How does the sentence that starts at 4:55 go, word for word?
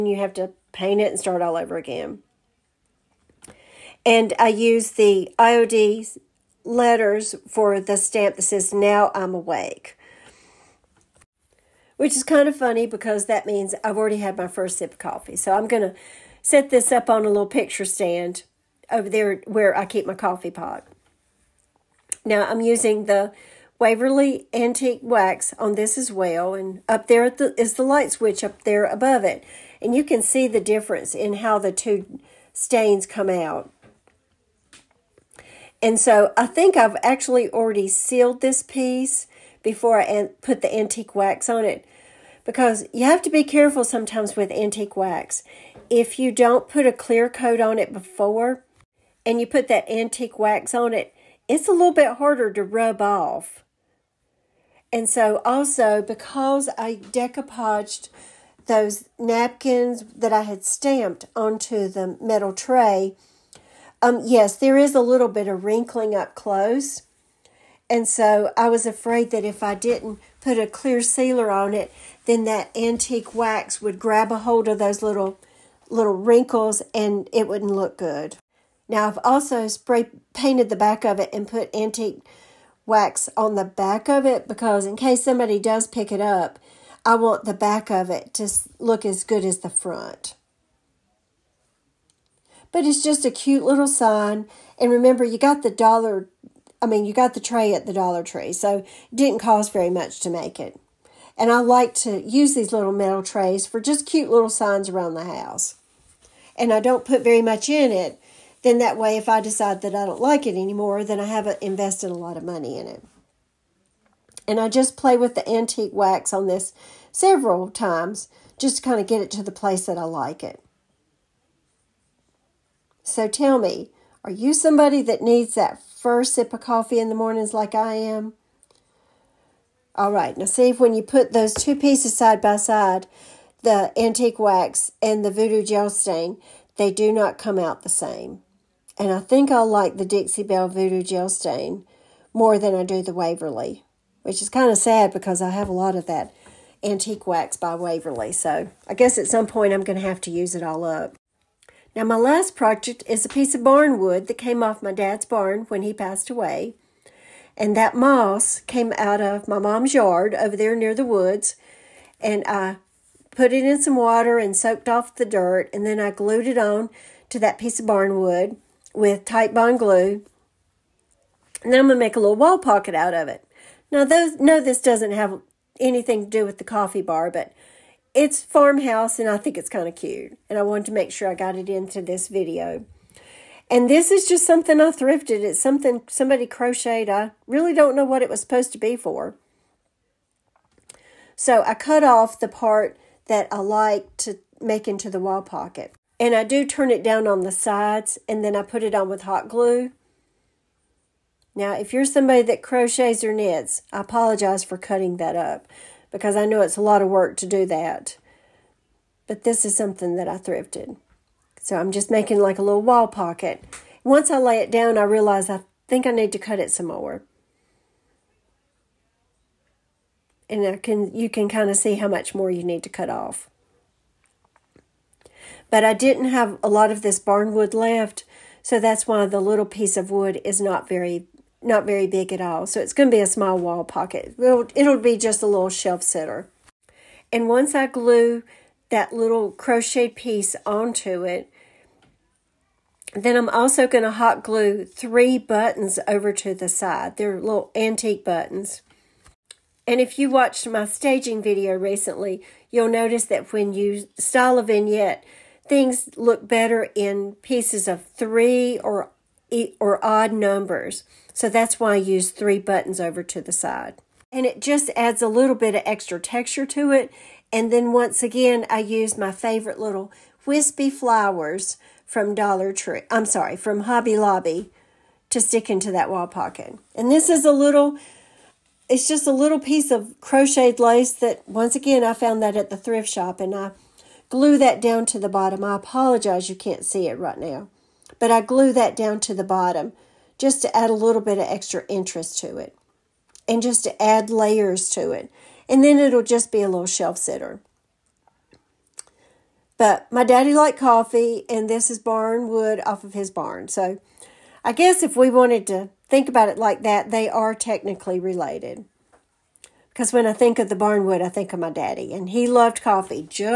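And then it'll just be a little shelf sitter.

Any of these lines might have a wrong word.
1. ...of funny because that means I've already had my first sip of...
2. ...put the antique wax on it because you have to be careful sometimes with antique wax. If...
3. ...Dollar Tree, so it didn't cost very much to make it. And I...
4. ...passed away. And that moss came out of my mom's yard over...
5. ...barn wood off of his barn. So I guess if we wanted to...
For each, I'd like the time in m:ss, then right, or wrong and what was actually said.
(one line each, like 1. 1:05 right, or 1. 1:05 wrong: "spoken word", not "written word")
1. 0:12 right
2. 0:40 right
3. 1:37 right
4. 2:35 right
5. 5:01 right.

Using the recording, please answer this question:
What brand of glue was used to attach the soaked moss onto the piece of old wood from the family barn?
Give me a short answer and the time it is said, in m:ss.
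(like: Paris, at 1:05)
Titebond, at 2:49.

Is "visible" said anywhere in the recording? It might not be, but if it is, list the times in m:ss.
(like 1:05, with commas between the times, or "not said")
not said.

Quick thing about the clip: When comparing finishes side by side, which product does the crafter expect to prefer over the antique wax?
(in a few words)
Dixie Belle Voodoo Gel Stain.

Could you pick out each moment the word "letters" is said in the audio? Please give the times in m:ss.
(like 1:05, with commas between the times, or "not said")
0:06.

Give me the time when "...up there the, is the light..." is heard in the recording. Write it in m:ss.
0:26.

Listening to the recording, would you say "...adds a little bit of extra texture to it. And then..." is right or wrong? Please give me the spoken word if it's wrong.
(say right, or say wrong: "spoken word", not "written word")
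right.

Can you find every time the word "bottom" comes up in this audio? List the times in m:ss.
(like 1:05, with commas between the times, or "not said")
4:45, 4:49.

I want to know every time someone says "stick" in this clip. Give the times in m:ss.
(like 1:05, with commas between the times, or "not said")
4:35.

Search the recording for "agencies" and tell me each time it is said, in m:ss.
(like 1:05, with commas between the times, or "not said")
not said.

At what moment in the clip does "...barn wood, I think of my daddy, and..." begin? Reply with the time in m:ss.
5:10.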